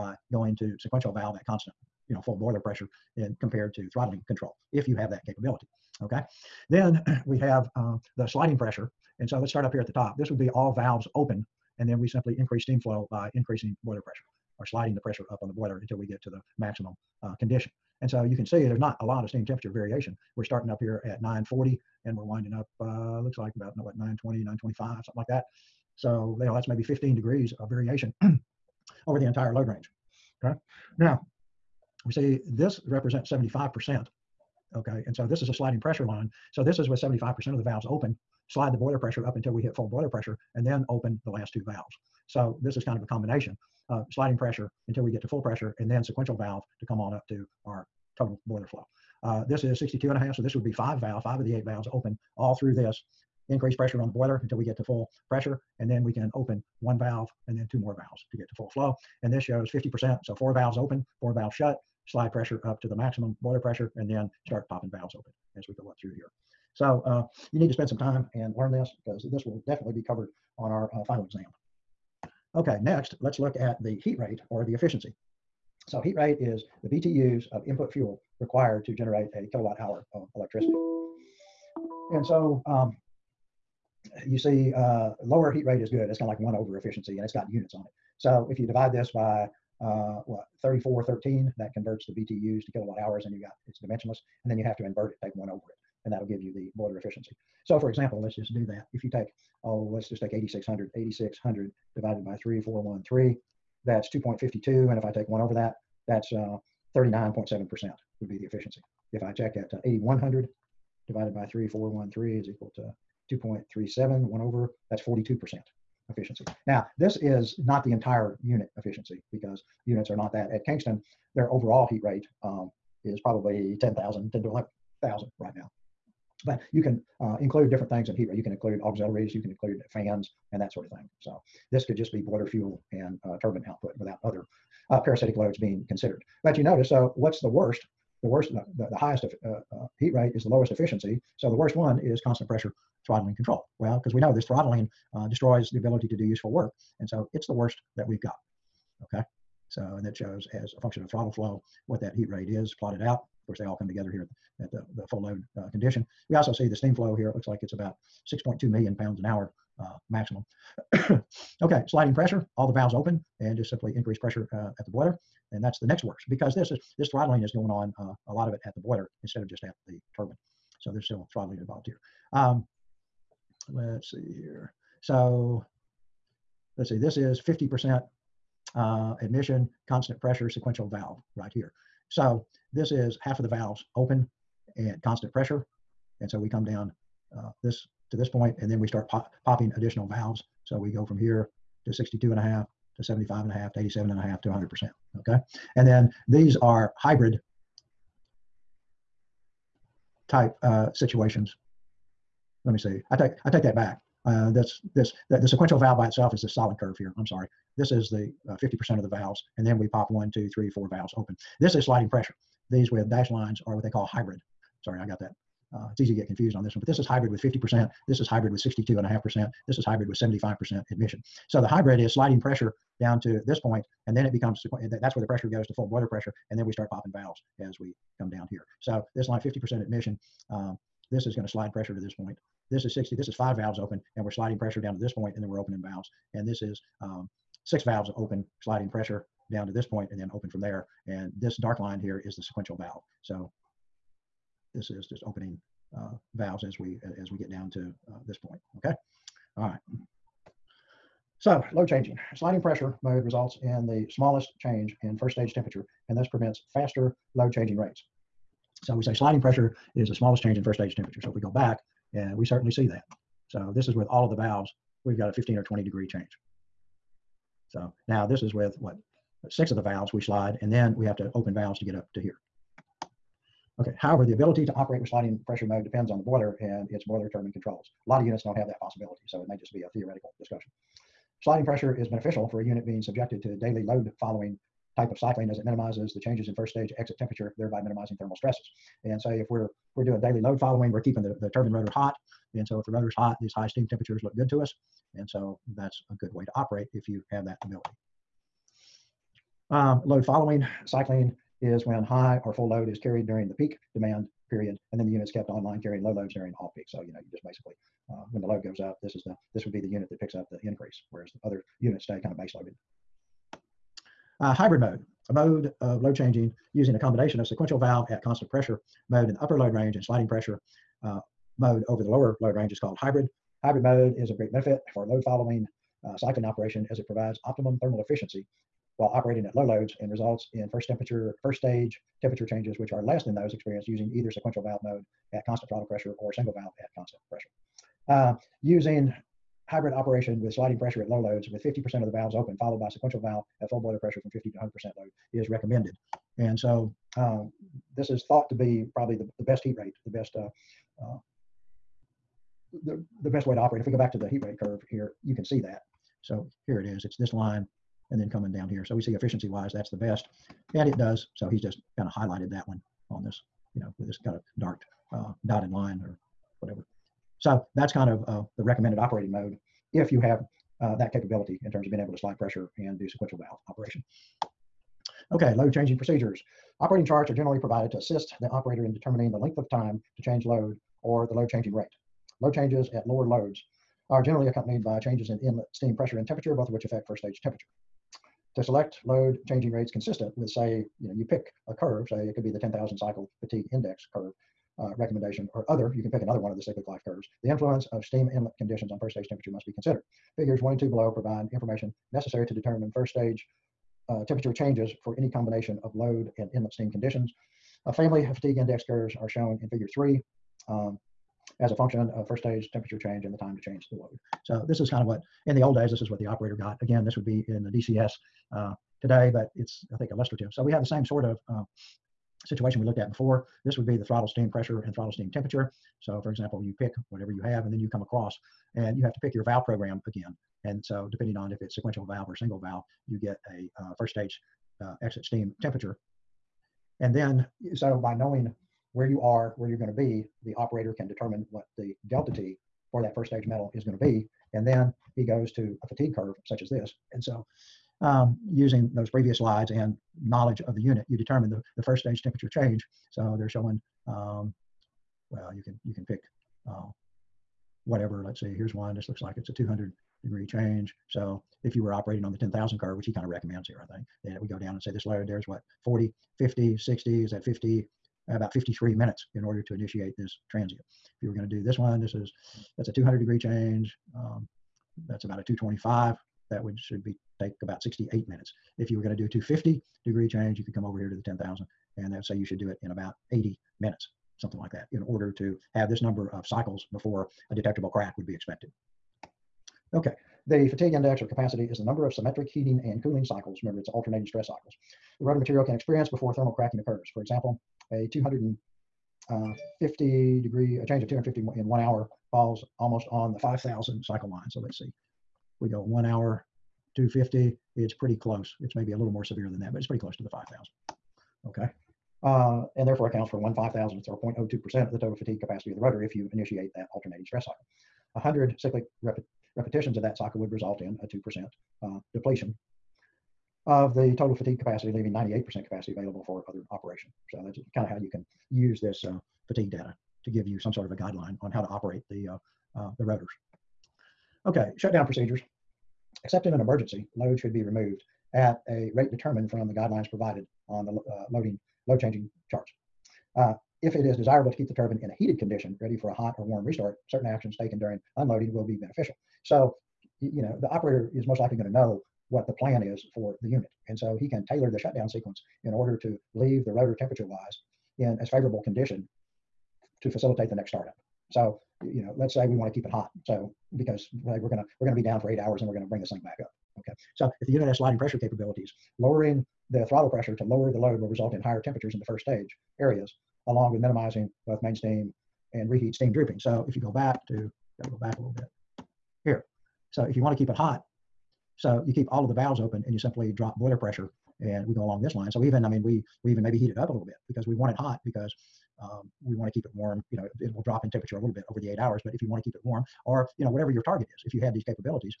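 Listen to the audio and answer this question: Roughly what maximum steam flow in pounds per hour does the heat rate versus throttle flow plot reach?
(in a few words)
6.2 million.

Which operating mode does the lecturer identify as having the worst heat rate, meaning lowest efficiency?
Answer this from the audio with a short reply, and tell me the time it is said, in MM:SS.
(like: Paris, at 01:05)
constant pressure throttling control, at 02:22.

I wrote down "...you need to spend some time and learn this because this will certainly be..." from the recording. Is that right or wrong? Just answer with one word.
wrong.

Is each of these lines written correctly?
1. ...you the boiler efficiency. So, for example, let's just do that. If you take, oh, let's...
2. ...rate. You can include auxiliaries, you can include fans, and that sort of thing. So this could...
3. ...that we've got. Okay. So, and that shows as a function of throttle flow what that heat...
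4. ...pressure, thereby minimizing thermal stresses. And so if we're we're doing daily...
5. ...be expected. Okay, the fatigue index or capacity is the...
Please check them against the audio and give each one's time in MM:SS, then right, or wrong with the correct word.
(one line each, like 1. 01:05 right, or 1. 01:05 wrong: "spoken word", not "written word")
1. 01:36 right
2. 02:08 right
3. 02:27 right
4. 04:47 wrong: "temperature", not "pressure"
5. 08:08 right.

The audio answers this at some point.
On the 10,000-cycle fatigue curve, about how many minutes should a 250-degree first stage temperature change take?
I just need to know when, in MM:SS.
08:03.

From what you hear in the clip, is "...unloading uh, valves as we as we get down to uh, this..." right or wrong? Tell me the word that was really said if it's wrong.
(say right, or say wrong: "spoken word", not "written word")
wrong: "opening", not "unloading".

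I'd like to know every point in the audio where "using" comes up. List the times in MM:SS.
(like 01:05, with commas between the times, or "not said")
05:16, 05:33, 05:38, 07:28.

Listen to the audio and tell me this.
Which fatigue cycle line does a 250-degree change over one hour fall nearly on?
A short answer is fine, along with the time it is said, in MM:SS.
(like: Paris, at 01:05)
5,000, at 08:23.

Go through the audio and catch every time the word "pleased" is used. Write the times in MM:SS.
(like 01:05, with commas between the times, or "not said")
not said.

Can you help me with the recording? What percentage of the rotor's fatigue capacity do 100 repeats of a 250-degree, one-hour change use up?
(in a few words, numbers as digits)
2%.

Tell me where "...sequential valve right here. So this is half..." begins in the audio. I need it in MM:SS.
03:00.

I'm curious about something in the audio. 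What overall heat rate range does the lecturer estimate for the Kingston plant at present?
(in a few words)
10,000 to 11,000.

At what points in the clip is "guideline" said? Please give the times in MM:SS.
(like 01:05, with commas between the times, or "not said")
08:50, 08:59.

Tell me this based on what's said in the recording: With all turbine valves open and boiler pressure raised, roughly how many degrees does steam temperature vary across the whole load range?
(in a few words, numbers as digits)
15.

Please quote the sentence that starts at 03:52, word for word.
This is 60, this is five valves open, and we're sliding pressure down to this point, and then we're opening valves.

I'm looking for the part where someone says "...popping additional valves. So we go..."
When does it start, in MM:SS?
03:09.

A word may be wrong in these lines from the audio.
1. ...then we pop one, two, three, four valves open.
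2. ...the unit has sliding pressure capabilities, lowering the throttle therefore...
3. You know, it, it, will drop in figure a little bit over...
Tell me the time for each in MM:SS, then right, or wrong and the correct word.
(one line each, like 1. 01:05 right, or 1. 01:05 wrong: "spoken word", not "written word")
1. 03:29 right
2. 09:27 wrong: "pressure", not "therefore"
3. 09:50 wrong: "temperature", not "figure".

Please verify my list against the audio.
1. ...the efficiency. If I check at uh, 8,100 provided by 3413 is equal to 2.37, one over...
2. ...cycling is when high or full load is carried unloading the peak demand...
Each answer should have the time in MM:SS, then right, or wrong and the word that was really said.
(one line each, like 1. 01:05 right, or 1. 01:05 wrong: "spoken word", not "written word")
1. 01:48 wrong: "divided", not "provided"
2. 05:00 wrong: "during", not "unloading".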